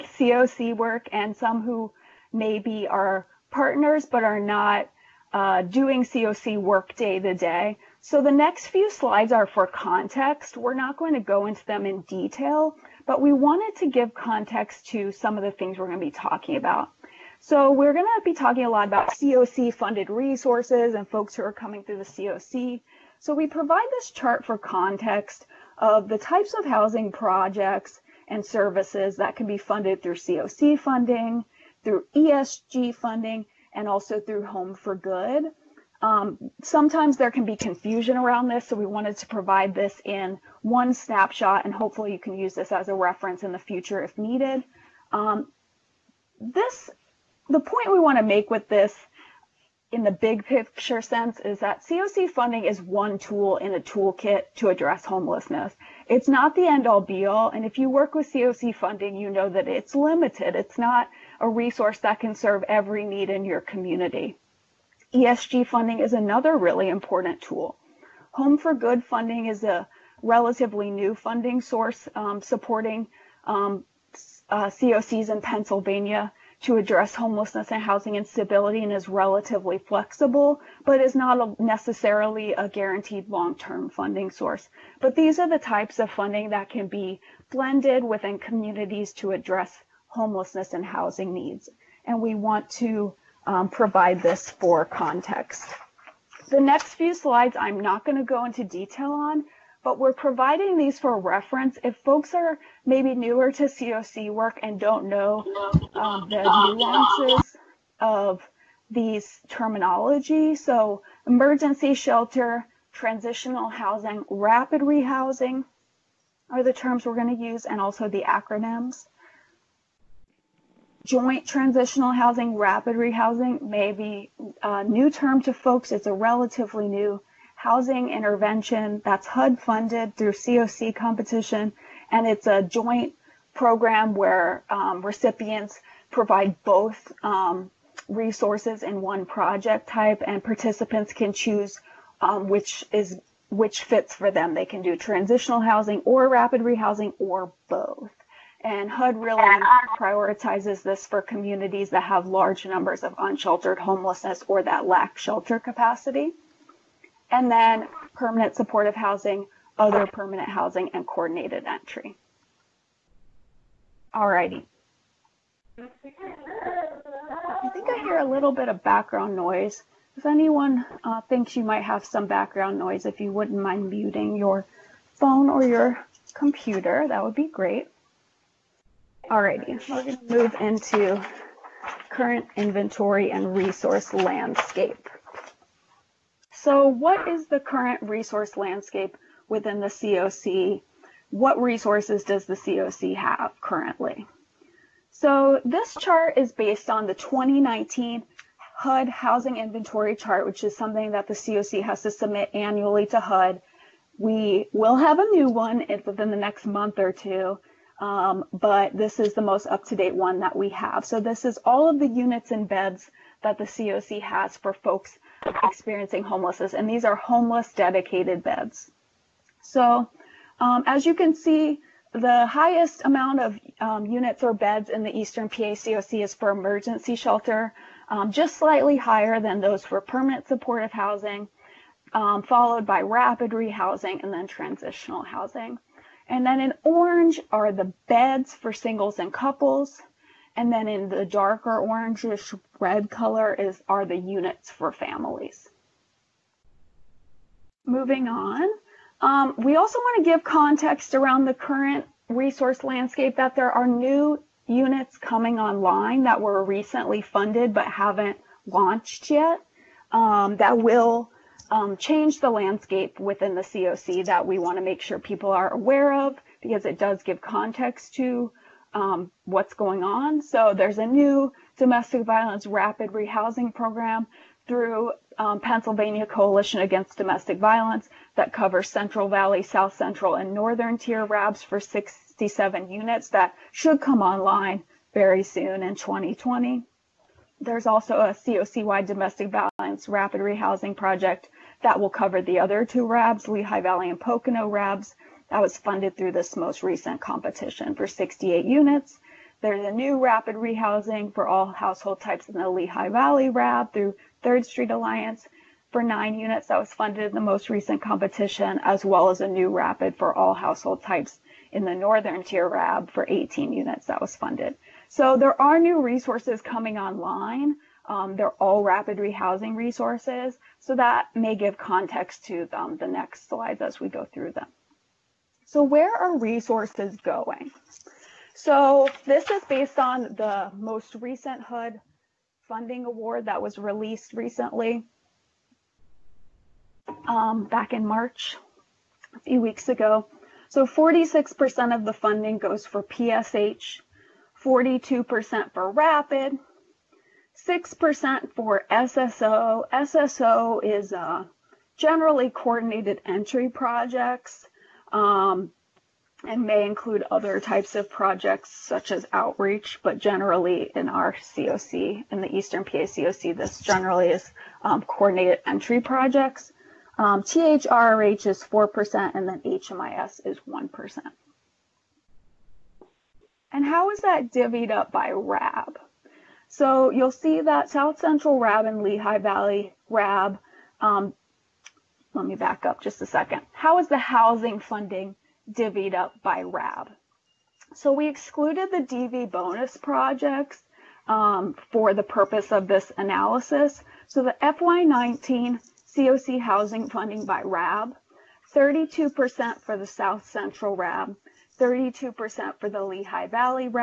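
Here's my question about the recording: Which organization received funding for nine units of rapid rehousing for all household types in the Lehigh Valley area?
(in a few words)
Third Street Alliance.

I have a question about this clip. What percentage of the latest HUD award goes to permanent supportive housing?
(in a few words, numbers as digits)
46%.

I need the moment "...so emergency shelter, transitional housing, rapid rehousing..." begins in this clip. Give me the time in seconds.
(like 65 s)
110 s.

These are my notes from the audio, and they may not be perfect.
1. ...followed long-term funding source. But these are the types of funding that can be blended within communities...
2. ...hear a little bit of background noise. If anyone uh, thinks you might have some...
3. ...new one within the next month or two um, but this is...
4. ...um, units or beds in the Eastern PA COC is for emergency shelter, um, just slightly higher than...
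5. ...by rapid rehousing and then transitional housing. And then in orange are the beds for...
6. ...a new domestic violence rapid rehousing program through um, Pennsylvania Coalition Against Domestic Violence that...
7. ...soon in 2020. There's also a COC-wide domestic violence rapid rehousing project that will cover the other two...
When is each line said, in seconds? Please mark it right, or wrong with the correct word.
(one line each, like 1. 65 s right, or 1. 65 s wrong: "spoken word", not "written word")
1. 82 s wrong: "guaranteed", not "followed"
2. 168 s right
3. 205 s right
4. 223 s right
5. 232 s right
6. 270 s right
7. 285 s right.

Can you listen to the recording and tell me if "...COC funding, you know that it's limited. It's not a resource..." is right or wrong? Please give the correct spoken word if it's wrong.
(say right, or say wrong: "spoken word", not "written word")
right.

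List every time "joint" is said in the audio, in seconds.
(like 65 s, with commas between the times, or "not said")
121 s, 132 s.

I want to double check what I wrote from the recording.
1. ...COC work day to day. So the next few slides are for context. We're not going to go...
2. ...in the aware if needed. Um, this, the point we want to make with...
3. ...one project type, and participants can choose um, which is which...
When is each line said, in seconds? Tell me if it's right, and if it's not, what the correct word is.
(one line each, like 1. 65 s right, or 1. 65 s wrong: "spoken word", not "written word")
1. 6 s right
2. 43 s wrong: "future", not "aware"
3. 139 s right.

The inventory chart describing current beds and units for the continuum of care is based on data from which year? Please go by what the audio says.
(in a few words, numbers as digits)
2019.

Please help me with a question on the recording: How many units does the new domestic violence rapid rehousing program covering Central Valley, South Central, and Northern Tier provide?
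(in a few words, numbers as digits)
67.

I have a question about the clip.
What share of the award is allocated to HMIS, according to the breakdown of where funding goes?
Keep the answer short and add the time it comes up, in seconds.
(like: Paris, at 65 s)
1%, at 369 s.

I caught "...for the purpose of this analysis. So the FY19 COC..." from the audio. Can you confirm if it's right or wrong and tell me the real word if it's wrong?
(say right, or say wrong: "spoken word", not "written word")
right.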